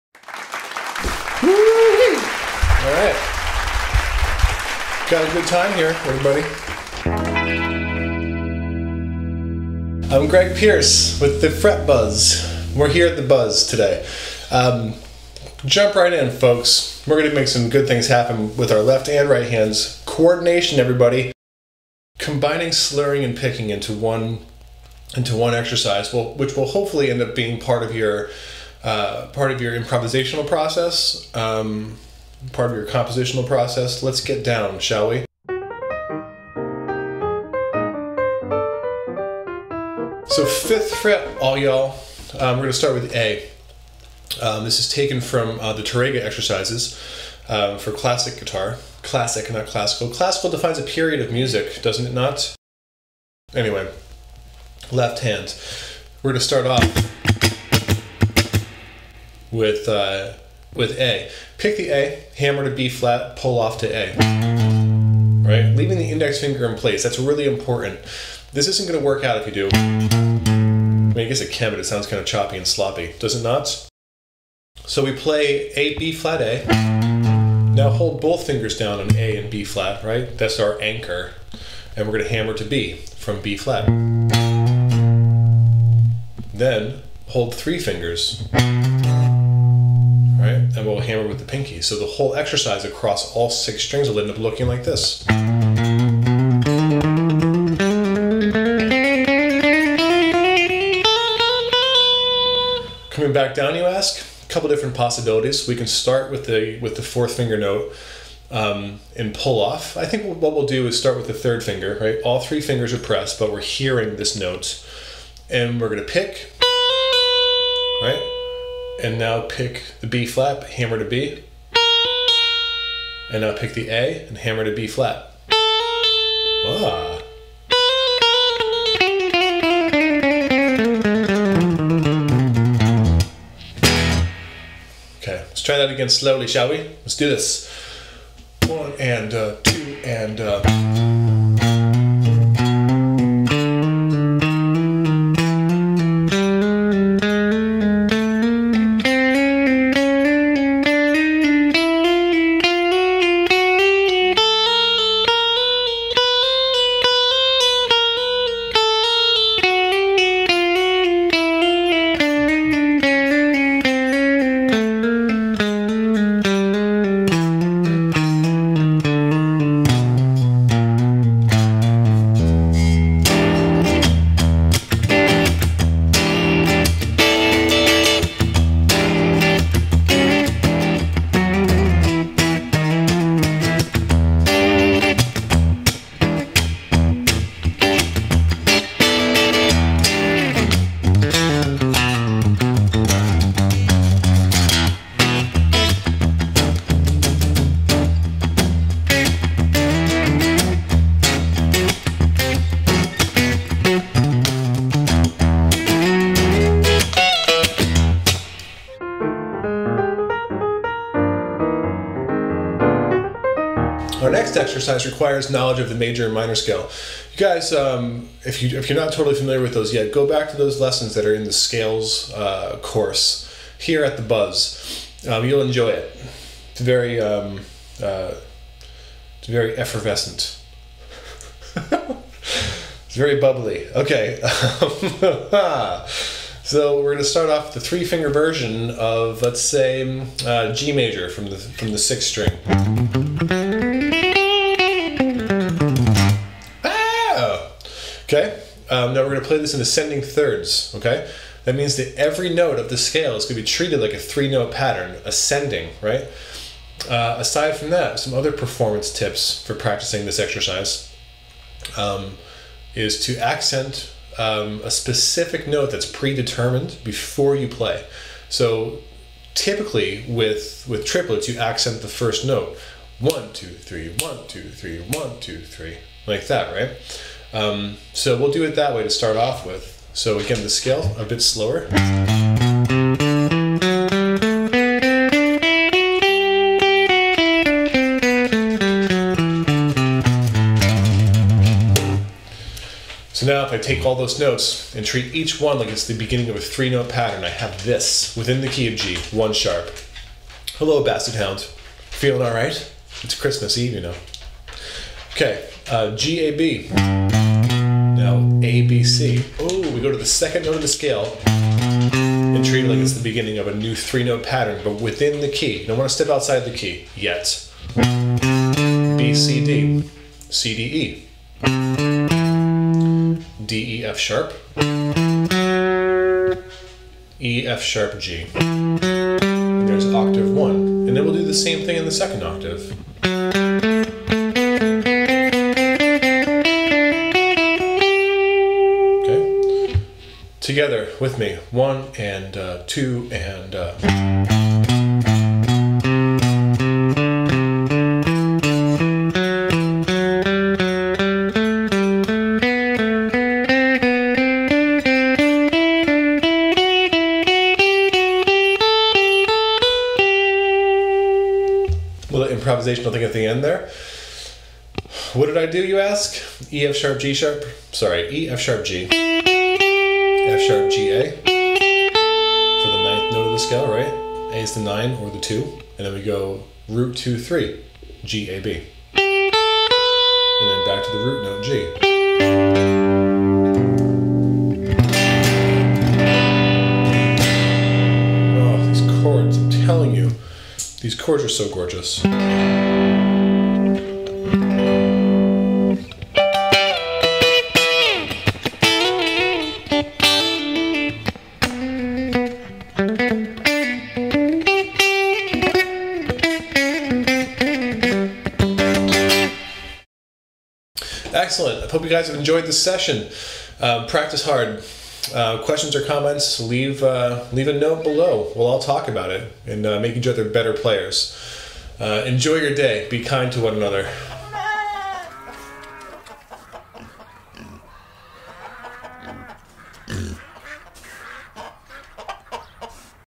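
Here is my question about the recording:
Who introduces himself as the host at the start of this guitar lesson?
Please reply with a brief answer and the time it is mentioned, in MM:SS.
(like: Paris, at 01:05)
Greg Pierce, at 00:10.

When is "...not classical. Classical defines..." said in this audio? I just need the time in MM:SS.
00:49.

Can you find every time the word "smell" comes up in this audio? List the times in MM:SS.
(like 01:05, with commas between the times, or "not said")
not said.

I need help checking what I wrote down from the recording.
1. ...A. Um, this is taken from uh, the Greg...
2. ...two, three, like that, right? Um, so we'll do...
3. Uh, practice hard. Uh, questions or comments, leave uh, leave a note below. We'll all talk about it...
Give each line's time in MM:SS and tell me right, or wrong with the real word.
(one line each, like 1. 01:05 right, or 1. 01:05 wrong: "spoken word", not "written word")
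1. 00:43 wrong: "Tarrega", not "Greg"
2. 04:35 right
3. 06:53 right.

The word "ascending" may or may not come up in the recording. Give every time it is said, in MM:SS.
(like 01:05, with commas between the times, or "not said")
04:09, 04:15.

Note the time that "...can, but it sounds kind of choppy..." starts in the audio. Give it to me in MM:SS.
01:11.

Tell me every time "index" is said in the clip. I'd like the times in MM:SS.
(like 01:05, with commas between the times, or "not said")
01:06.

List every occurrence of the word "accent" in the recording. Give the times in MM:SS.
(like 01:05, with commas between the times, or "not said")
04:23, 04:31.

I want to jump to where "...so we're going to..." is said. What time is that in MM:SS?
03:56.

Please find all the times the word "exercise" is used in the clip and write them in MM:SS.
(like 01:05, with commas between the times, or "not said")
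00:25, 00:46, 01:32, 03:34, 04:20.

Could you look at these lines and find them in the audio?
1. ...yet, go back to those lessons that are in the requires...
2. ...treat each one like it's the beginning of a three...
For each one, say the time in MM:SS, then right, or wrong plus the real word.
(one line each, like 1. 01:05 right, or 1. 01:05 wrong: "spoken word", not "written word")
1. 03:39 wrong: "scales", not "requires"
2. 04:55 right.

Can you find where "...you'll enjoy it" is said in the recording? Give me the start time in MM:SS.
03:45.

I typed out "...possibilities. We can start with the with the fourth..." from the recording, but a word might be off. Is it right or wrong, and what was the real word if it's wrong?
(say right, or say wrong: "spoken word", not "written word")
right.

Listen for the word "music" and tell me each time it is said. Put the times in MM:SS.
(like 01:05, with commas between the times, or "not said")
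00:51.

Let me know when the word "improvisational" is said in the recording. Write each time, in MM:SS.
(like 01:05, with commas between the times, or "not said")
00:29, 06:02.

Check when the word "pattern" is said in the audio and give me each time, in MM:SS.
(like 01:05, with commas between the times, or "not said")
04:14, 04:57, 05:14.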